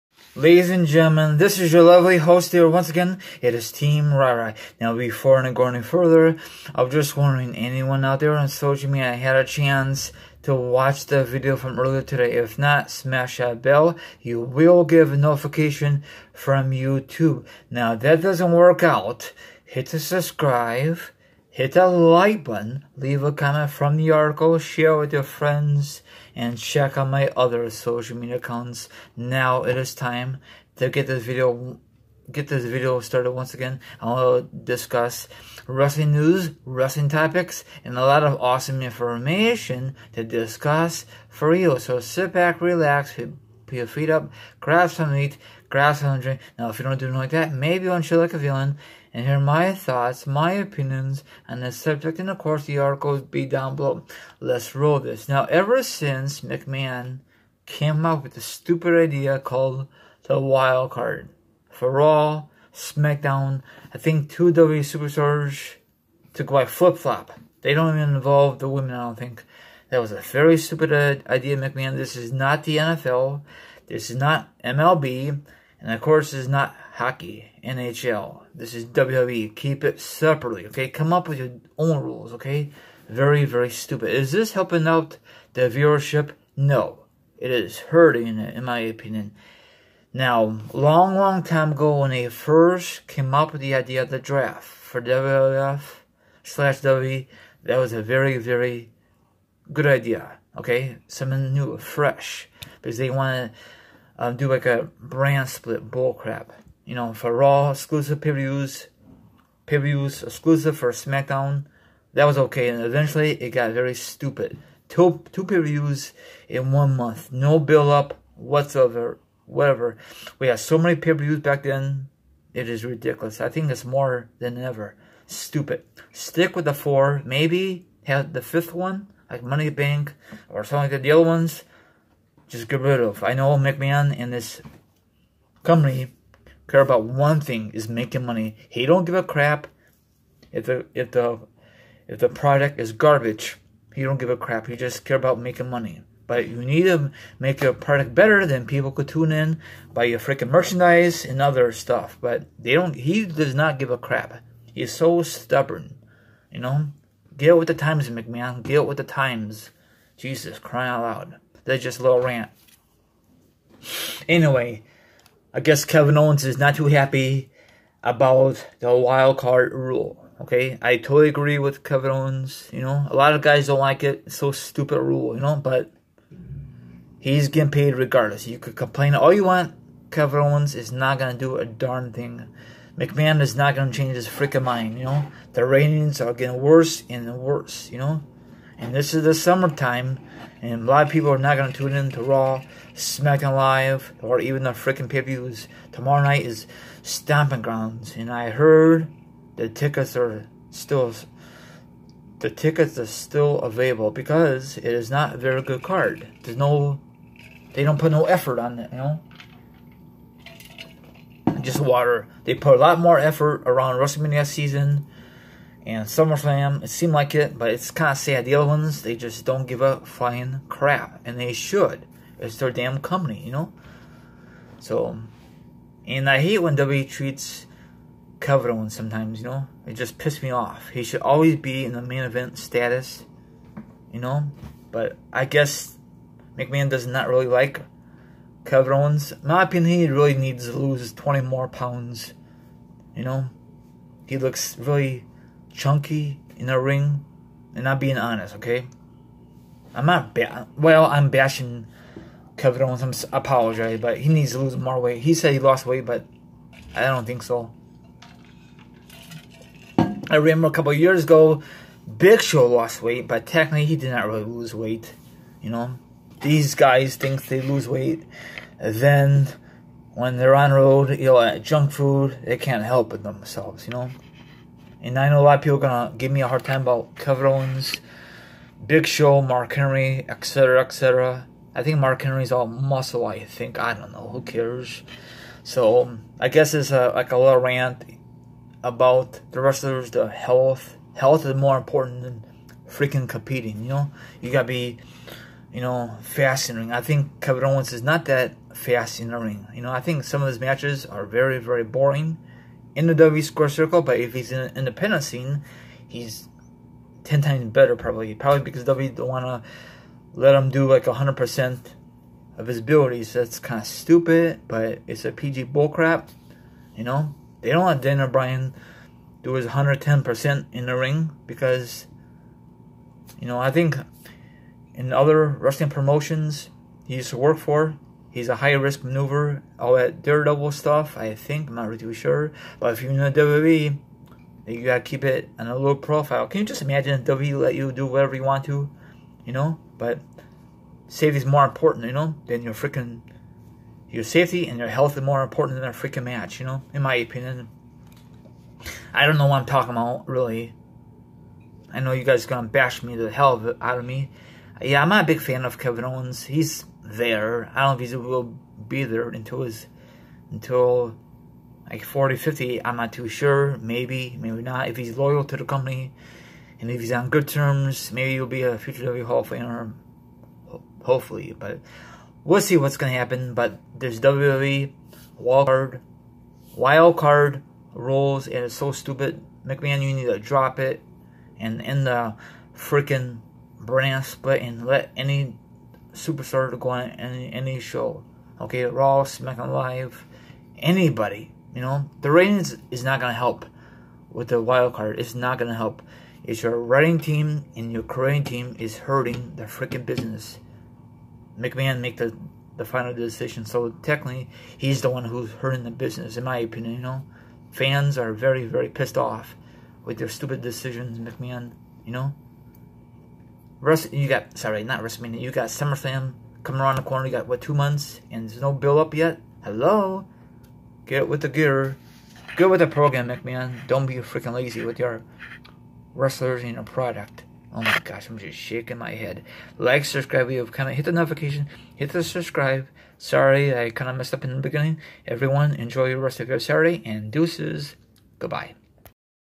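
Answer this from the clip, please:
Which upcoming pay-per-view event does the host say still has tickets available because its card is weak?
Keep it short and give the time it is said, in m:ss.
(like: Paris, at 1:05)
Stomping Grounds, at 3:17.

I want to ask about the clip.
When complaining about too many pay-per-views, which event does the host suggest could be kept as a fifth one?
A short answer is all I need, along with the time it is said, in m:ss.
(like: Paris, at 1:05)
Money Bank, at 2:09.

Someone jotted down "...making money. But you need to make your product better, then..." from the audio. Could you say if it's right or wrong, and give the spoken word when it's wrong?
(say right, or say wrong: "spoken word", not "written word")
right.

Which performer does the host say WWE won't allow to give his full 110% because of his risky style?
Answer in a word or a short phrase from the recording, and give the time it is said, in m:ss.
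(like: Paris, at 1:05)
Dan Bryan, at 5:18.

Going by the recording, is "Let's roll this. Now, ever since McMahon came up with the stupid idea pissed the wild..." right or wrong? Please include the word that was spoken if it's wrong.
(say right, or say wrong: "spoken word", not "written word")
wrong: "called", not "pissed".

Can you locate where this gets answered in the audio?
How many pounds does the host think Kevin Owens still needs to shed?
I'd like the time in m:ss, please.
4:01.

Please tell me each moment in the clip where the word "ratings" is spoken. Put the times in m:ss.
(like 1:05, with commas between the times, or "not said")
3:05, 6:32.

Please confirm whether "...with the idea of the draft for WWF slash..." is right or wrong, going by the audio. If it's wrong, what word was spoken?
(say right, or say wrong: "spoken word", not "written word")
right.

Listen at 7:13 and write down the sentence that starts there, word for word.
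Sorry, I kind of messed up in the beginning.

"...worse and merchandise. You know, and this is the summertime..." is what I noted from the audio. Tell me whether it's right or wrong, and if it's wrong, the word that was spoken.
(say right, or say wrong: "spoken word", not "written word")
wrong: "worse", not "merchandise".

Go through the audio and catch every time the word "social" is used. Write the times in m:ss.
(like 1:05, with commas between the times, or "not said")
0:08, 0:27.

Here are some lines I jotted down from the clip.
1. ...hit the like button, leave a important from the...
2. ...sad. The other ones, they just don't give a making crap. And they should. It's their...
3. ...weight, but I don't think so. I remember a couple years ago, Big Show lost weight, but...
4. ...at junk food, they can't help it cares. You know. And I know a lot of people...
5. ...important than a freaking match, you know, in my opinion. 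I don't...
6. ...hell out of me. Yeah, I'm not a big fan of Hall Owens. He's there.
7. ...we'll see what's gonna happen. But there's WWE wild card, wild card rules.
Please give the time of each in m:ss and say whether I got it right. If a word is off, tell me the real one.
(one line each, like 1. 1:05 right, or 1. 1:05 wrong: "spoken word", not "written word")
1. 0:21 wrong: "comment", not "important"
2. 3:38 wrong: "flying", not "making"
3. 4:15 right
4. 4:31 wrong: "themselves", not "cares"
5. 5:45 right
6. 5:53 wrong: "Kevin", not "Hall"
7. 6:12 right.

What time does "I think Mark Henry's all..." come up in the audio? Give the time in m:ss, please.
4:41.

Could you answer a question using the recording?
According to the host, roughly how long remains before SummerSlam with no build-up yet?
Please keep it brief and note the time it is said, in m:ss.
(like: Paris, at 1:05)
two months, at 6:57.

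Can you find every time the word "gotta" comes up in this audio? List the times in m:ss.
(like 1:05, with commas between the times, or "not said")
4:54, 5:34.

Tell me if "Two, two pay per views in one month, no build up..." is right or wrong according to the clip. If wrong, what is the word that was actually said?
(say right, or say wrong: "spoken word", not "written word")
right.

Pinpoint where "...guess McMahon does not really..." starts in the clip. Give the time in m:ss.
3:55.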